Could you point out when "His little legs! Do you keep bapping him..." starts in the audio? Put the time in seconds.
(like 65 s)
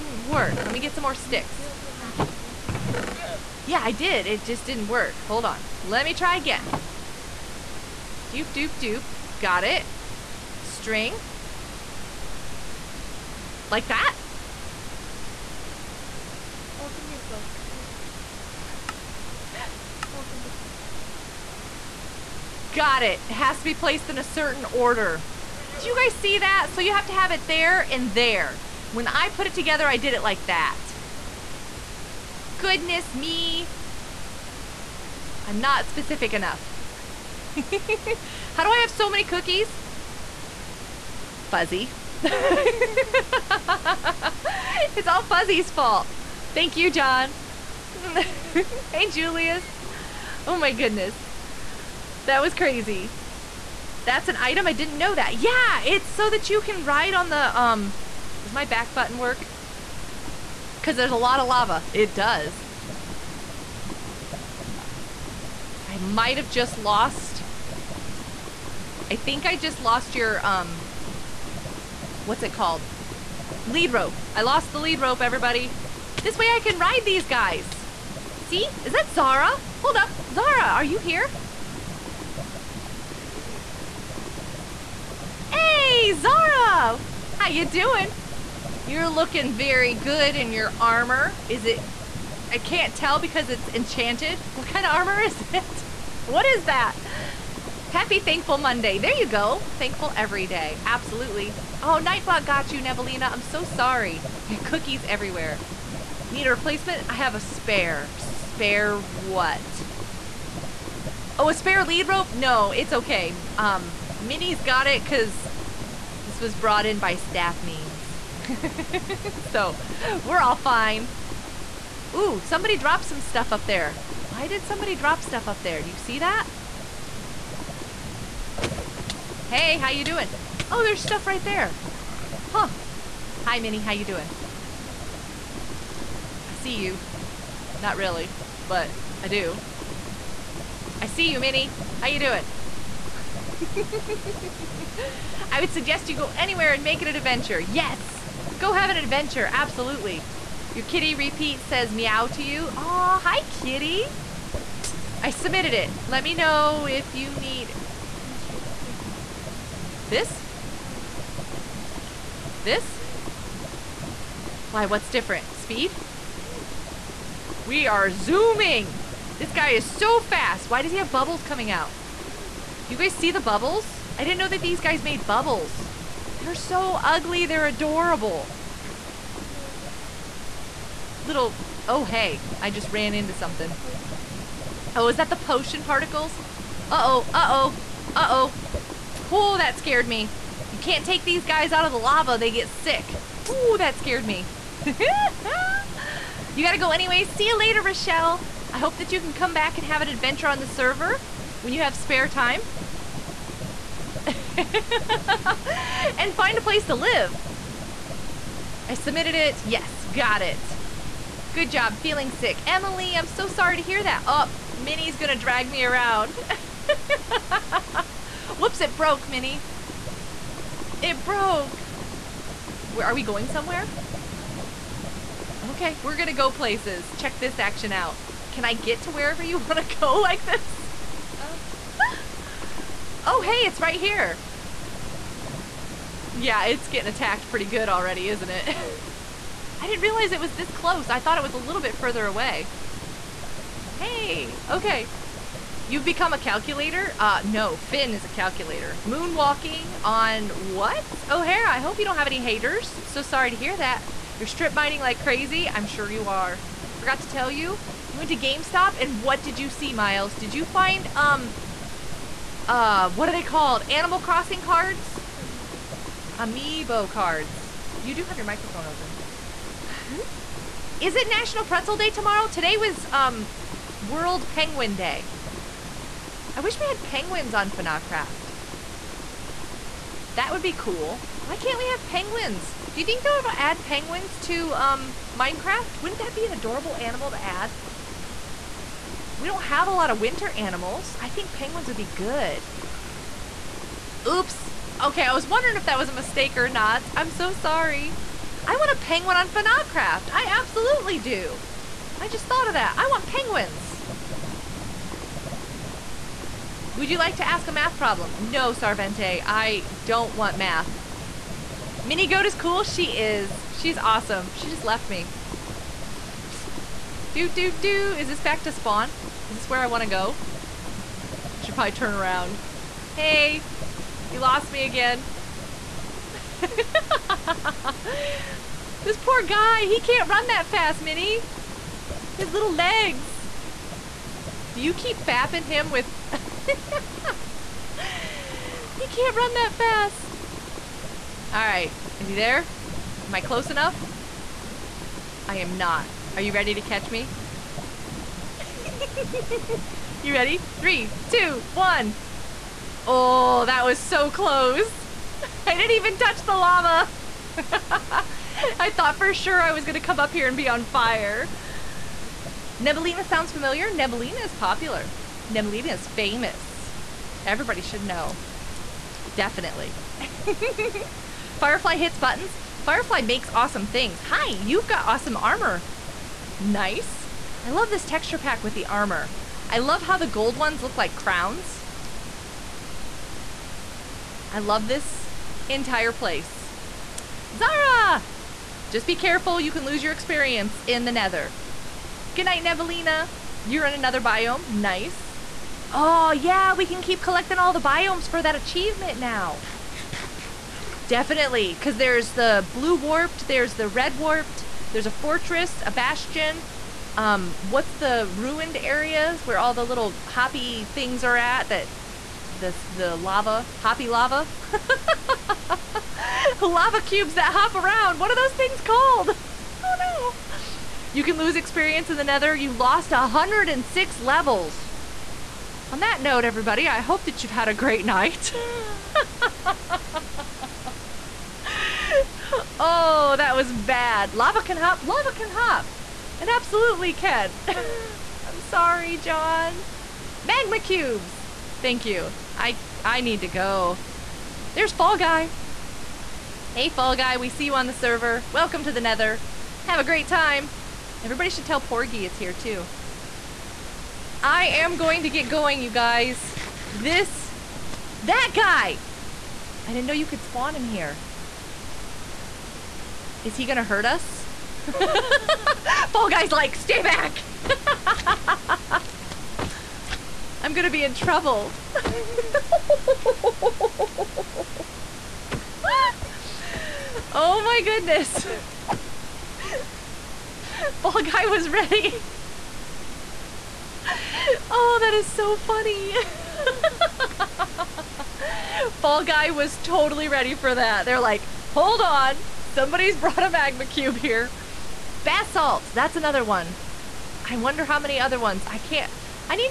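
332 s.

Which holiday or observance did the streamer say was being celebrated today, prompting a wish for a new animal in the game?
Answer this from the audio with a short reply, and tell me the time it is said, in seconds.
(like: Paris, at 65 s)
World Penguin Day, at 274 s.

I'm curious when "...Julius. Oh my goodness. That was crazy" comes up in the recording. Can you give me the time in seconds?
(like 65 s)
49 s.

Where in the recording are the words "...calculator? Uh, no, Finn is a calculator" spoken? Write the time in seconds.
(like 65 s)
246 s.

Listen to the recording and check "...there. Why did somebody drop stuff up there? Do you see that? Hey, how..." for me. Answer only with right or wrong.
right.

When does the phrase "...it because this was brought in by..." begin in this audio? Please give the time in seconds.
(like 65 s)
114 s.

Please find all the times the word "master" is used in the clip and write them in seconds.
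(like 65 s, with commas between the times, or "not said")
not said.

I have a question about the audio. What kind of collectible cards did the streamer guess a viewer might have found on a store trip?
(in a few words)
Amiibo cards.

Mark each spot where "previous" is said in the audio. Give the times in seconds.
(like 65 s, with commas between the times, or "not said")
not said.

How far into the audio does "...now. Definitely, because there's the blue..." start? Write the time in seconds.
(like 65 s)
399 s.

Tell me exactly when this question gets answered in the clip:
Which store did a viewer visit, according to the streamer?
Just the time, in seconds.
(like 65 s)
258 s.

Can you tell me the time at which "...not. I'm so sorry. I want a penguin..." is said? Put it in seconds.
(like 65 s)
296 s.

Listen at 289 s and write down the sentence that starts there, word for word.
We don't have a lot of winter animals.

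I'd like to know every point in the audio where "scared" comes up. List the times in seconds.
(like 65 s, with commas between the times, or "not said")
189 s, 193 s.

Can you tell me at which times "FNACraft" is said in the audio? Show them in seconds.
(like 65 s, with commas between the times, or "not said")
277 s, 299 s.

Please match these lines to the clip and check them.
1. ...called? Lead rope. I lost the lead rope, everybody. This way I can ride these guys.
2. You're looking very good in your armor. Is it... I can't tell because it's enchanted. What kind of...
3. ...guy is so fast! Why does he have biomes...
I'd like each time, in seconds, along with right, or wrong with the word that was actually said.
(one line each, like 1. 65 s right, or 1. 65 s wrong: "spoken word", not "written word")
1. 72 s right
2. 88 s right
3. 169 s wrong: "bubbles", not "biomes".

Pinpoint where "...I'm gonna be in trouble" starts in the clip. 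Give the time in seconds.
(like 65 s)
470 s.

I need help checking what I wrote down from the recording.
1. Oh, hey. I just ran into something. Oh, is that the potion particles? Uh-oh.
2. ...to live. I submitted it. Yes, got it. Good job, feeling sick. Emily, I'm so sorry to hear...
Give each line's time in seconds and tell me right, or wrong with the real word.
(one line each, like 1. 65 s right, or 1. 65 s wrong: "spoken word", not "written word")
1. 181 s right
2. 206 s right.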